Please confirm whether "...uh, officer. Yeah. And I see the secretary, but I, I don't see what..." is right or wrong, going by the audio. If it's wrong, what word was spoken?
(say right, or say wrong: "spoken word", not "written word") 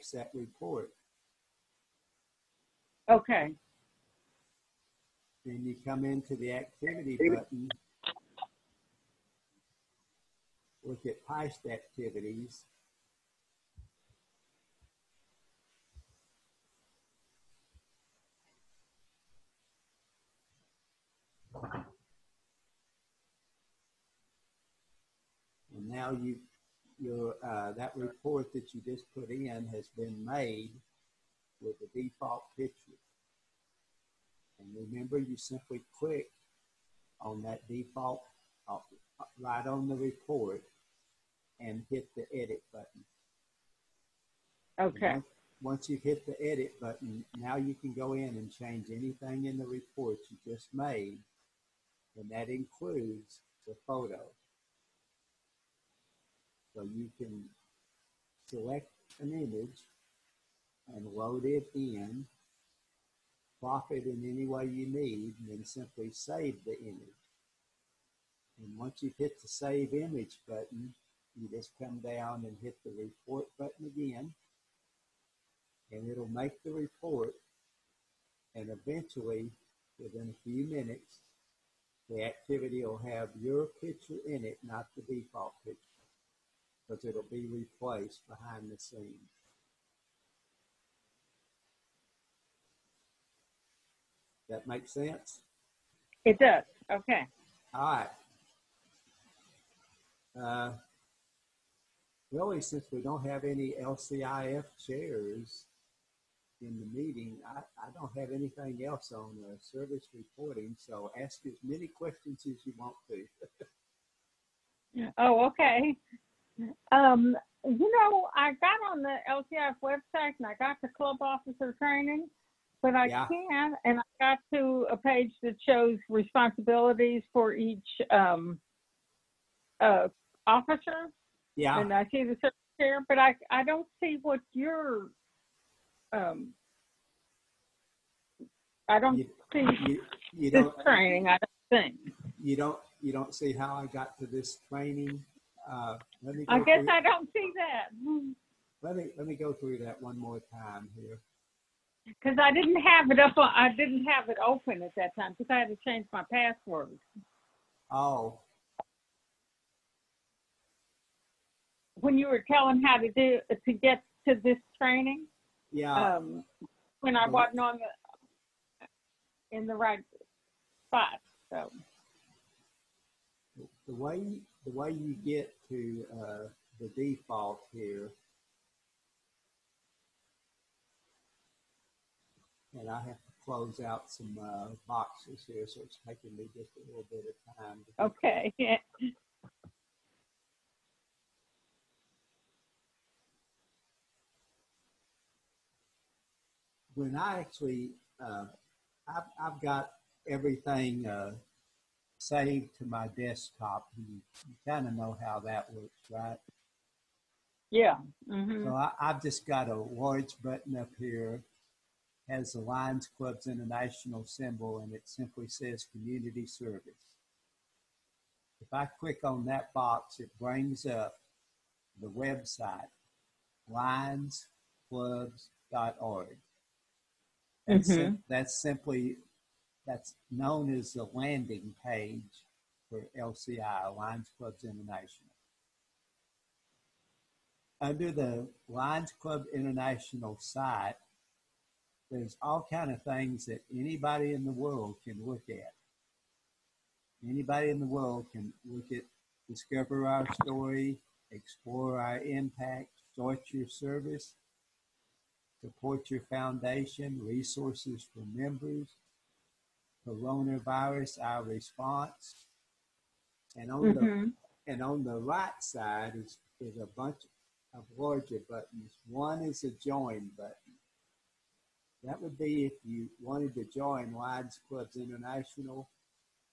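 right.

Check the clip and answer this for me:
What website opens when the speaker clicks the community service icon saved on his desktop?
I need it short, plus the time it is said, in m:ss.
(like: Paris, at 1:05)
lionsclubs.org, at 3:43.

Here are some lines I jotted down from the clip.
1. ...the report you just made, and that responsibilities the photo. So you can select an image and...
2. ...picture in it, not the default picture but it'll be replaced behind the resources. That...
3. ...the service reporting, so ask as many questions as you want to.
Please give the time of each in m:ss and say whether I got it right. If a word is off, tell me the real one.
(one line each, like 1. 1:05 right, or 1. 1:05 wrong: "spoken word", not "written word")
1. 0:49 wrong: "includes", not "responsibilities"
2. 1:23 wrong: "scenes", not "resources"
3. 1:49 right.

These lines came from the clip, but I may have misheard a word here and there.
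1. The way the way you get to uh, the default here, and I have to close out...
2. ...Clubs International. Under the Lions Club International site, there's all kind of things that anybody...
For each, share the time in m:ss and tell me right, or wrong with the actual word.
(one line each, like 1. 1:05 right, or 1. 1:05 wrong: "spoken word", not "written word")
1. 2:53 right
2. 3:54 right.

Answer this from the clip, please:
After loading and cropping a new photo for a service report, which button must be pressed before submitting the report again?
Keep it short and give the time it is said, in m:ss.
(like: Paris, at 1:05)
Save Image, at 1:09.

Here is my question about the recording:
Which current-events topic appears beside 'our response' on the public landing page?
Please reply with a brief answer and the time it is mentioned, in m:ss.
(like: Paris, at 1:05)
Coronavirus, at 4:20.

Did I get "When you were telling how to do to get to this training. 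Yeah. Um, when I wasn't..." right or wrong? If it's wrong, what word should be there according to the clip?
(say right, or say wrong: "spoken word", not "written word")
right.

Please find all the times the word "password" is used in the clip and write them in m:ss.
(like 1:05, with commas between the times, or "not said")
2:36.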